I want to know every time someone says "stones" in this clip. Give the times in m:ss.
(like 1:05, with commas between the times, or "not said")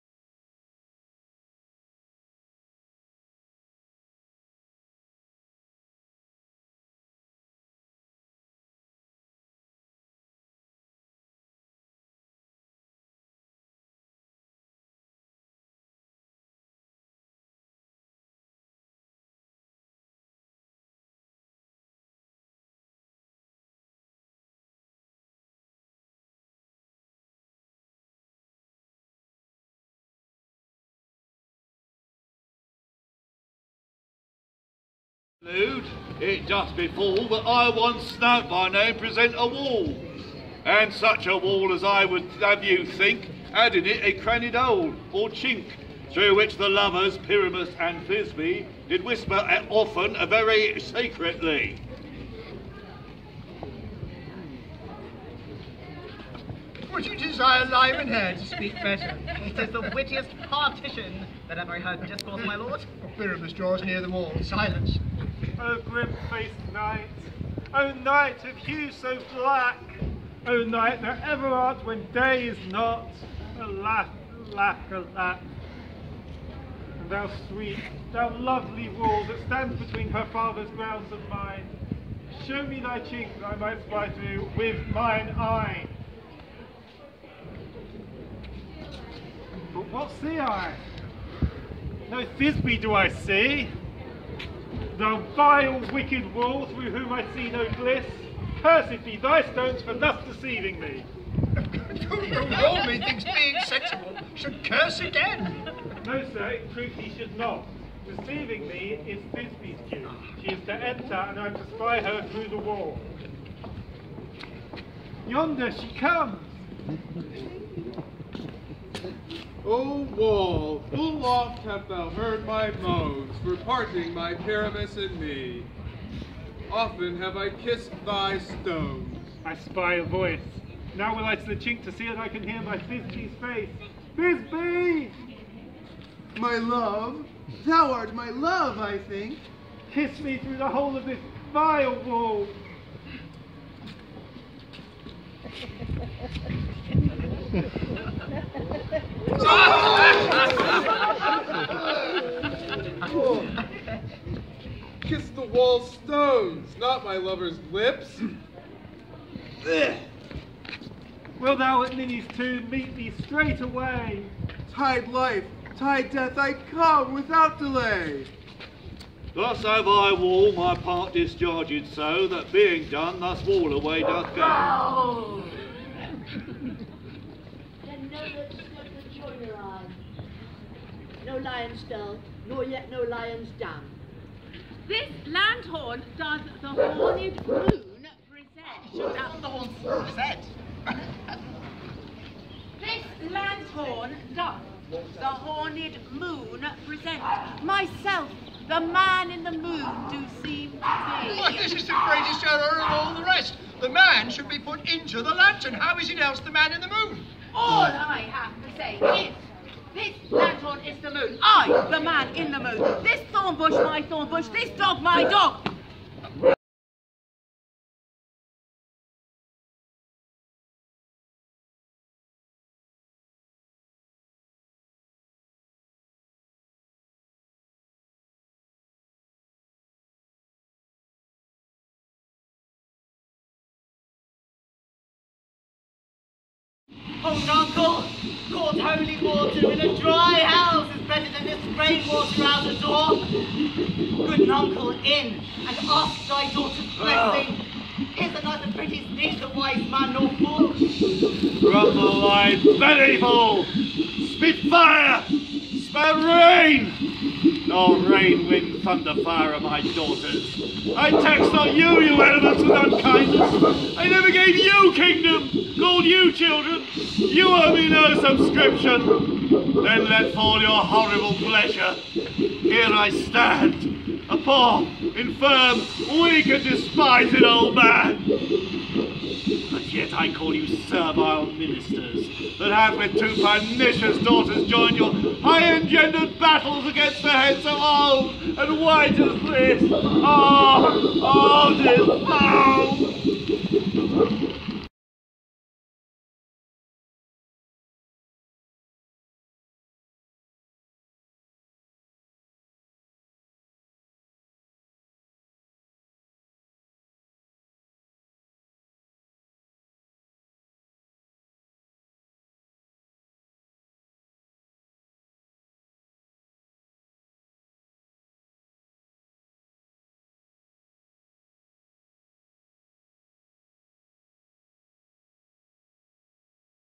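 1:39, 2:08, 2:35.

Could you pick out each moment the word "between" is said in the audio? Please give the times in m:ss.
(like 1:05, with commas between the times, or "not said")
1:19.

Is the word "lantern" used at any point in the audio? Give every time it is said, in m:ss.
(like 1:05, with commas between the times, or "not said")
3:25, 3:30.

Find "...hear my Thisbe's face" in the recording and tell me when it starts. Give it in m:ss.
2:12.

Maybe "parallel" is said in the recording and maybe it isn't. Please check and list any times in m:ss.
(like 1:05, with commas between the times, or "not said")
not said.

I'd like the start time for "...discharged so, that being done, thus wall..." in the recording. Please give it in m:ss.
2:51.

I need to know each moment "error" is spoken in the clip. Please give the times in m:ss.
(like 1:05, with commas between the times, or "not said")
3:22.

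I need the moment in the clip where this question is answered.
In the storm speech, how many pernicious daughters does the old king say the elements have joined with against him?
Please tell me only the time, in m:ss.
4:43.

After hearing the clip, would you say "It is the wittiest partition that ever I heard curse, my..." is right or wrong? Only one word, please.
wrong.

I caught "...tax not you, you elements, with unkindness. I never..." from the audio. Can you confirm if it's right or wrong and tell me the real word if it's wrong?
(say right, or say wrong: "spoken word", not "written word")
right.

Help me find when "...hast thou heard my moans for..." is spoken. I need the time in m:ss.
2:01.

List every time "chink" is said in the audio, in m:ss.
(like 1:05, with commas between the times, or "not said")
0:45, 2:11.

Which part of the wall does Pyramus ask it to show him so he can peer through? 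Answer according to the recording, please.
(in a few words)
Cheek.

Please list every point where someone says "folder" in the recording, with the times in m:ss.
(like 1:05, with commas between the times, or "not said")
not said.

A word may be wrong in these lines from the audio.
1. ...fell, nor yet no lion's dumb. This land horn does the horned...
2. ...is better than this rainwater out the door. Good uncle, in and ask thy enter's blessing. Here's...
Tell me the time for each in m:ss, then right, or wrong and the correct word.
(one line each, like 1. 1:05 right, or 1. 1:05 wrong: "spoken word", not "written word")
1. 3:01 right
2. 4:00 wrong: "daughter", not "enter".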